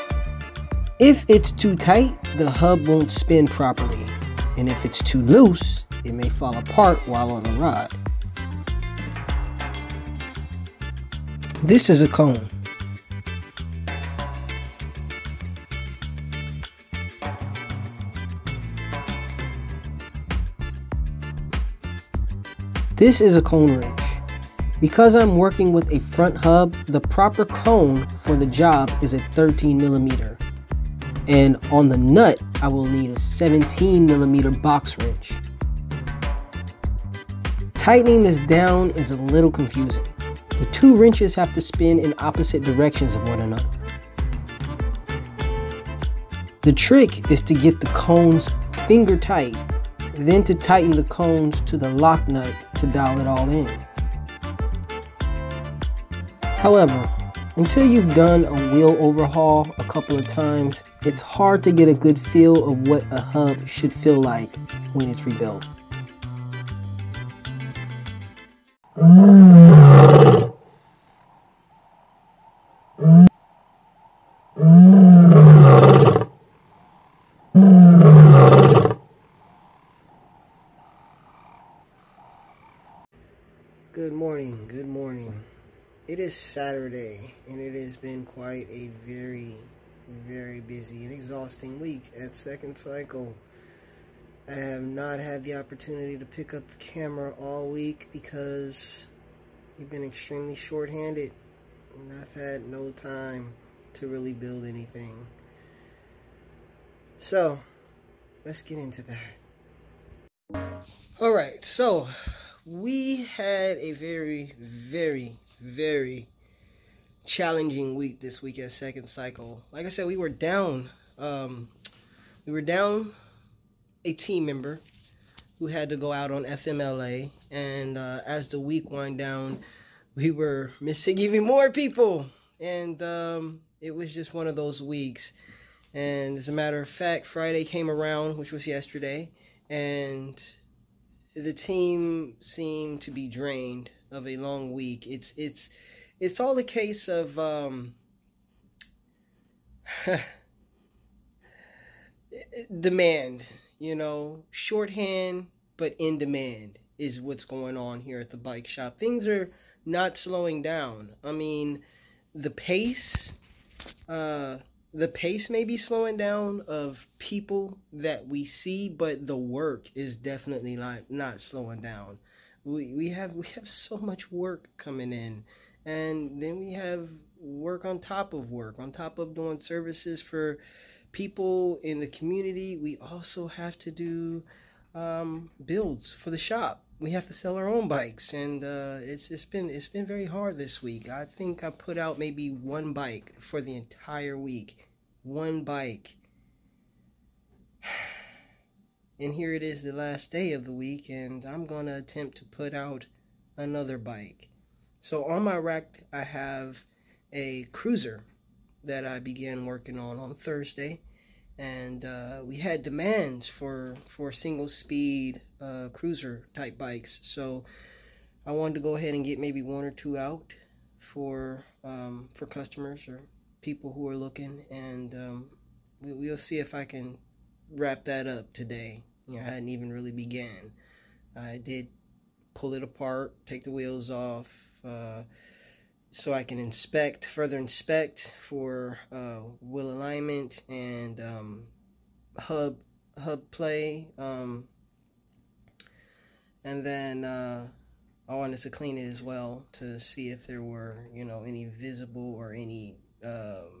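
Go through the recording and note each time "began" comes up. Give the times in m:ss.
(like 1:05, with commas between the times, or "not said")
3:29, 3:50.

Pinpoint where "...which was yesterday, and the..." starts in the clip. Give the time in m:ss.
2:18.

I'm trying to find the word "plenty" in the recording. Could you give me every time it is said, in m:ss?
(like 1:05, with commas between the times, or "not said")
not said.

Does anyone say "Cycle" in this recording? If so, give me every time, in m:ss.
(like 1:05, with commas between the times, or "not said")
1:32, 1:59.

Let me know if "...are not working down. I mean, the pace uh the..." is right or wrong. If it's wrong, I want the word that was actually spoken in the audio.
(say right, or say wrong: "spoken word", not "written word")
wrong: "slowing", not "working".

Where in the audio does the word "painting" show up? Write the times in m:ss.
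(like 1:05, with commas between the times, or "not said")
not said.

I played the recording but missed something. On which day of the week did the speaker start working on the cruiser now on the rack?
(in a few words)
Thursday.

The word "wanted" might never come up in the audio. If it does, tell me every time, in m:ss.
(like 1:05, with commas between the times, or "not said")
3:38, 4:08.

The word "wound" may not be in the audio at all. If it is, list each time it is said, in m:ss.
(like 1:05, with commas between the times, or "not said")
2:08.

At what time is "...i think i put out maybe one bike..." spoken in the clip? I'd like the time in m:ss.
3:11.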